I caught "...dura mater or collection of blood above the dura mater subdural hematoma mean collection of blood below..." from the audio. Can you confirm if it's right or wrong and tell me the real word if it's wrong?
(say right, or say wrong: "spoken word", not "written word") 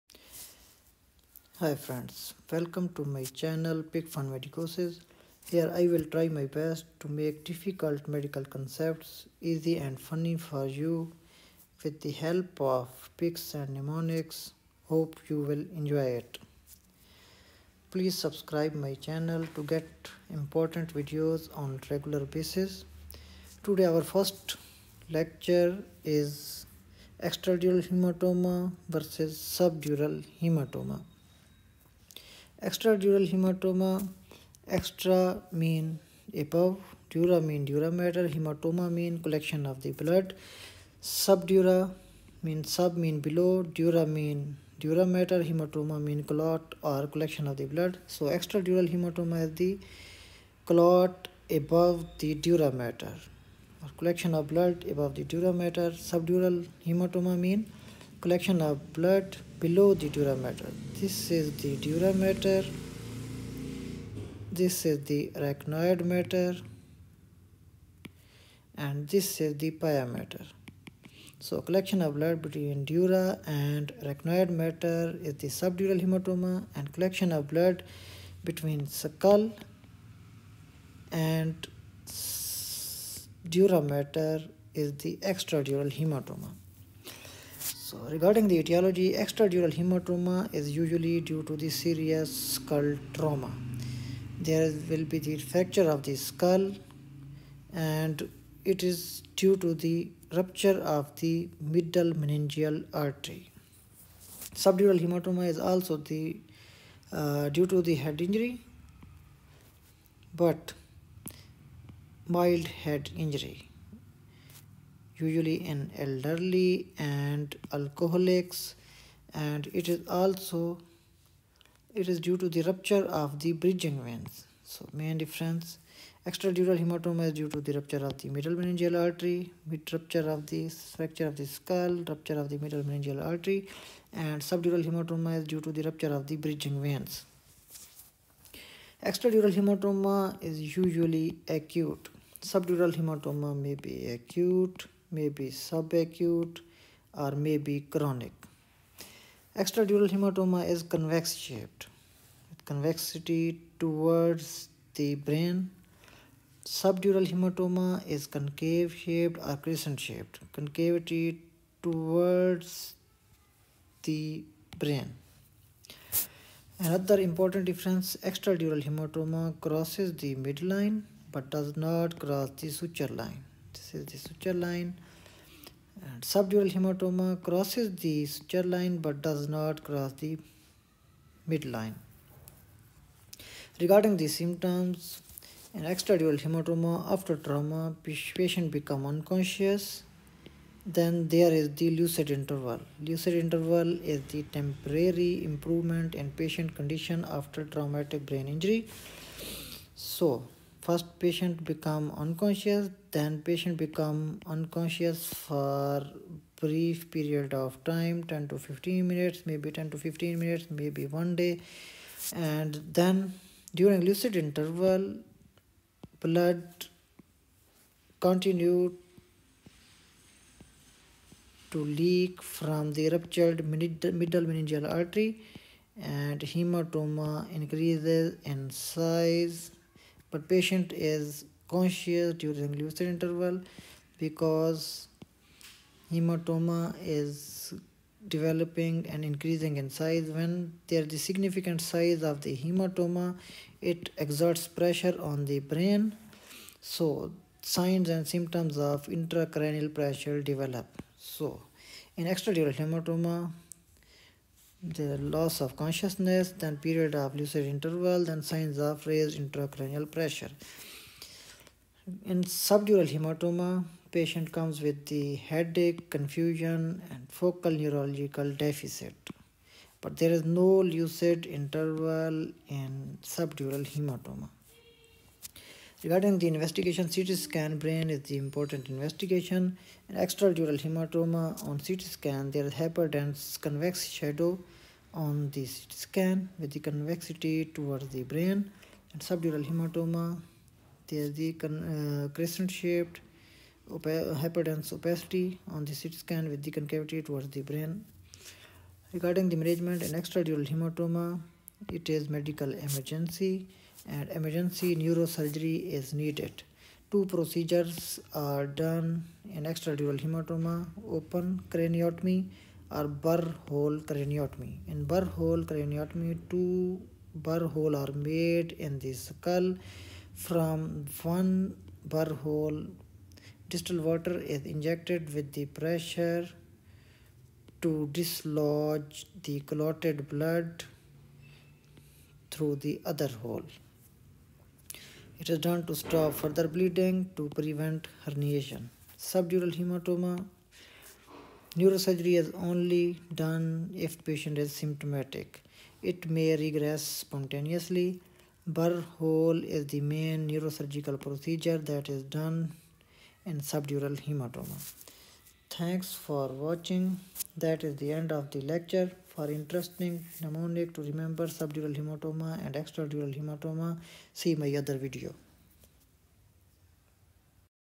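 right.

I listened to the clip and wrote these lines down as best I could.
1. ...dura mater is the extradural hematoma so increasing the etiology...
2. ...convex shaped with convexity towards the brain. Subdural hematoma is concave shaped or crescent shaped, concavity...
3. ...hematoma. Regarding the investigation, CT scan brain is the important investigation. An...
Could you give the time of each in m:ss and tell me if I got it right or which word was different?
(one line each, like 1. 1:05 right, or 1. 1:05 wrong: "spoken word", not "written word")
1. 1:23 wrong: "regarding", not "increasing"
2. 2:30 right
3. 4:33 right.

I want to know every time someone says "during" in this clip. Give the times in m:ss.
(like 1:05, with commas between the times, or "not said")
3:33, 3:52.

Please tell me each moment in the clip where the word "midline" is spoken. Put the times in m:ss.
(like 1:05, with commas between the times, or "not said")
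2:50, 3:01.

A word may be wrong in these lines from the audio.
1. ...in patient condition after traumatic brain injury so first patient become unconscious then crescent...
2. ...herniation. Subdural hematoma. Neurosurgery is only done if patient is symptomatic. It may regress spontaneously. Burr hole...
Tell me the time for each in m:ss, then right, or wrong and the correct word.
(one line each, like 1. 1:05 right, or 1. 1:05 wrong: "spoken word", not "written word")
1. 3:16 wrong: "patient", not "crescent"
2. 5:38 right.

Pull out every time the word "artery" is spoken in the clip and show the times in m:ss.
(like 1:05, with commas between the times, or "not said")
1:42, 2:09, 2:13, 3:44.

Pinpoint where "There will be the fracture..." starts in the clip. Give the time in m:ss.
1:34.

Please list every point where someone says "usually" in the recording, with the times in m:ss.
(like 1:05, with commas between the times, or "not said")
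1:30, 1:55, 2:20.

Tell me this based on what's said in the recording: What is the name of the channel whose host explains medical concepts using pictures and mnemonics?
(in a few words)
PicFun Medicosis.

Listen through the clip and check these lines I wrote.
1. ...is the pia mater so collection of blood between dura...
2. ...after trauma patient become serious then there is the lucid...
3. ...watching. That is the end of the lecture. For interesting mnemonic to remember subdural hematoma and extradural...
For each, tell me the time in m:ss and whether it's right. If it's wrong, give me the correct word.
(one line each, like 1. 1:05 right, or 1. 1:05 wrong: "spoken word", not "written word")
1. 1:09 right
2. 3:07 wrong: "unconscious", not "serious"
3. 5:56 right.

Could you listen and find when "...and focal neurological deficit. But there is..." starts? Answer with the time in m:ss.
4:27.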